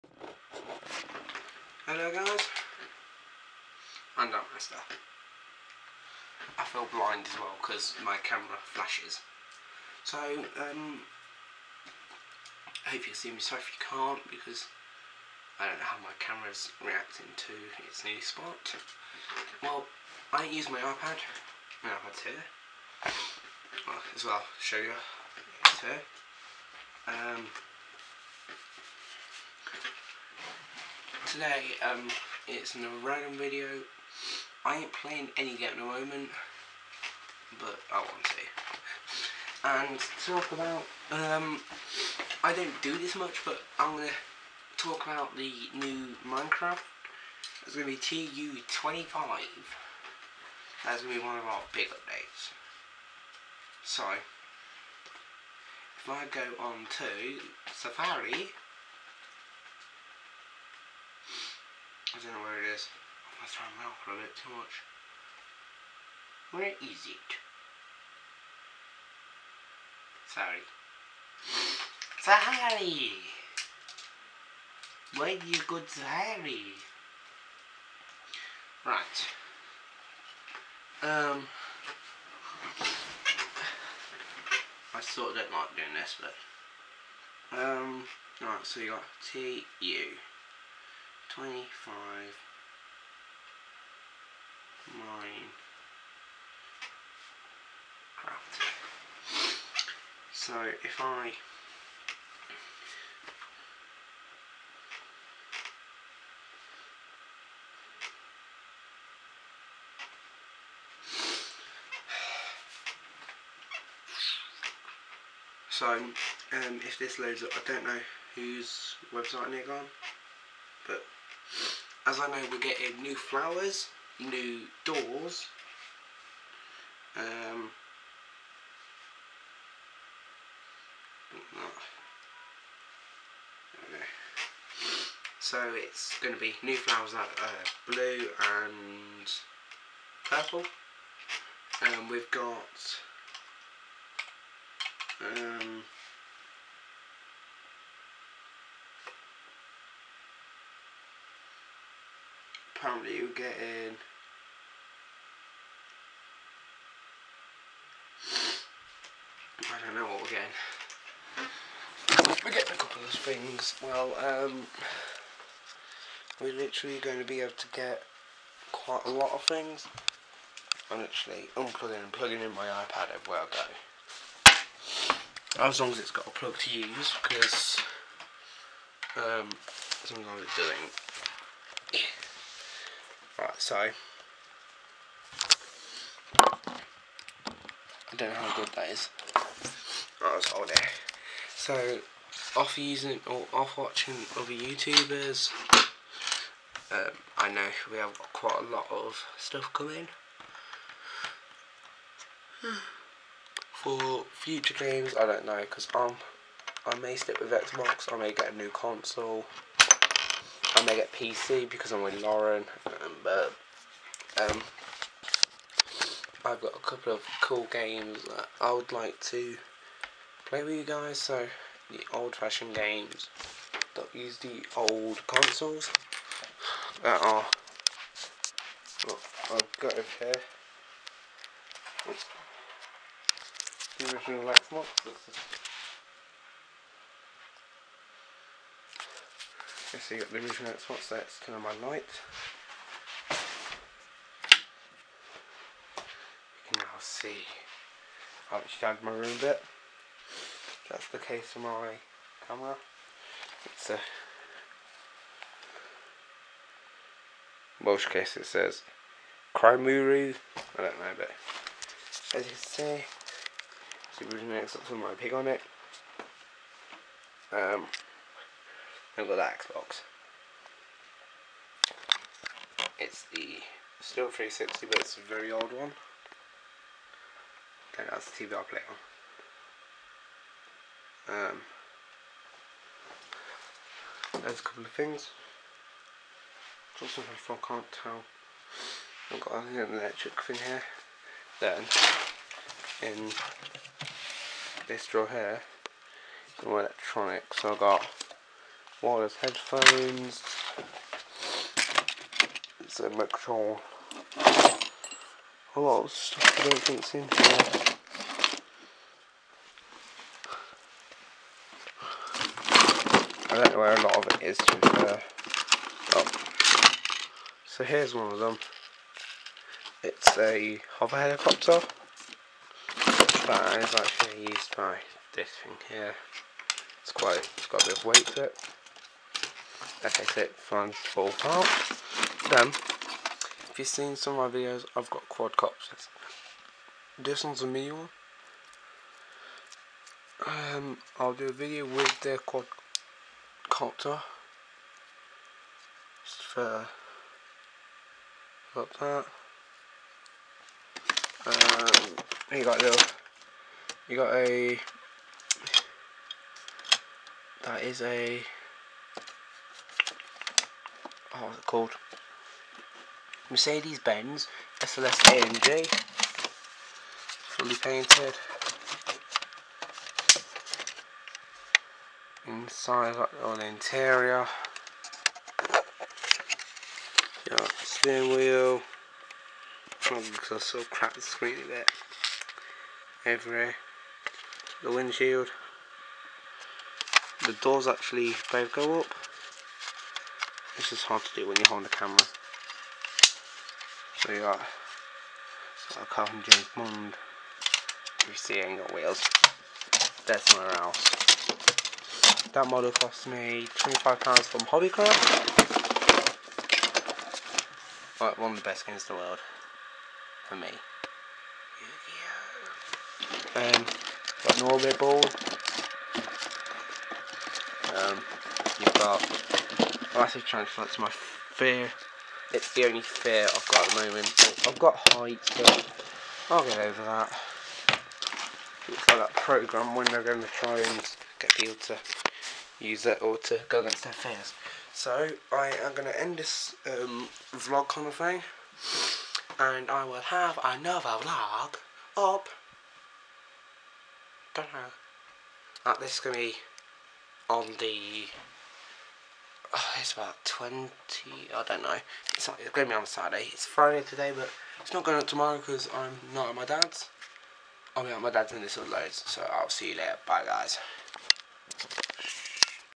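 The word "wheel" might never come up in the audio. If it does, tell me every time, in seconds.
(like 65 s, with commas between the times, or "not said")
378 s, 398 s.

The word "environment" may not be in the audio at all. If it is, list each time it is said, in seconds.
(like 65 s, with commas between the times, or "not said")
not said.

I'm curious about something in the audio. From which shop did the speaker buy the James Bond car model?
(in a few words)
Hobbycraft.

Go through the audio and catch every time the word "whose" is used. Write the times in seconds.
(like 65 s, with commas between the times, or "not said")
118 s.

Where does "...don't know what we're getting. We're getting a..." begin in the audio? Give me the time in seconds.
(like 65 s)
159 s.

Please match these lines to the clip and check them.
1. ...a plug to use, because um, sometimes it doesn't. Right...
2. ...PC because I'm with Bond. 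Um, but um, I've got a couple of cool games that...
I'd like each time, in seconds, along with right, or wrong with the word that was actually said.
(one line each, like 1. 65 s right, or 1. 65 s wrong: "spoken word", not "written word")
1. 176 s right
2. 211 s wrong: "Lauren", not "Bond".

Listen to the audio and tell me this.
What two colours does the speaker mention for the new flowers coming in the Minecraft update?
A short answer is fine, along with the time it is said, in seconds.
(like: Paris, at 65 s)
blue and purple, at 137 s.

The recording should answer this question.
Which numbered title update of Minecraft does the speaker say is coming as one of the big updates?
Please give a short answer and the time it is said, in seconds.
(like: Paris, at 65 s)
TU25, at 47 s.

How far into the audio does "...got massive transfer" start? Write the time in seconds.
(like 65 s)
418 s.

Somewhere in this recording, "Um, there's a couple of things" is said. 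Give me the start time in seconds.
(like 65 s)
281 s.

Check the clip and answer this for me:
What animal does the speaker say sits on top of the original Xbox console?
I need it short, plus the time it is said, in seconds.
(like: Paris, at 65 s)
pig, at 265 s.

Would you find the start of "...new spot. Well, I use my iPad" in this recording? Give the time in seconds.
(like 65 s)
18 s.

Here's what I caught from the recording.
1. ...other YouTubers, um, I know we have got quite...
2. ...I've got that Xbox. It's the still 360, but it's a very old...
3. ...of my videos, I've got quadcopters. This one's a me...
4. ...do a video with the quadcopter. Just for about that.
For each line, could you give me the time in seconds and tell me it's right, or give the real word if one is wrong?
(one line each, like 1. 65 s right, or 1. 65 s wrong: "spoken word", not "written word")
1. 194 s right
2. 269 s right
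3. 334 s right
4. 341 s right.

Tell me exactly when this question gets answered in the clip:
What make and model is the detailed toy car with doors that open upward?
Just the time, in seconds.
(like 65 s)
363 s.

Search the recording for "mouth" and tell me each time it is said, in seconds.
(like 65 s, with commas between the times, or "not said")
63 s.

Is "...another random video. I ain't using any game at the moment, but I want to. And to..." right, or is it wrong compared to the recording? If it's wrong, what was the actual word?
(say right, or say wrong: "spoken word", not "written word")
wrong: "playing", not "using".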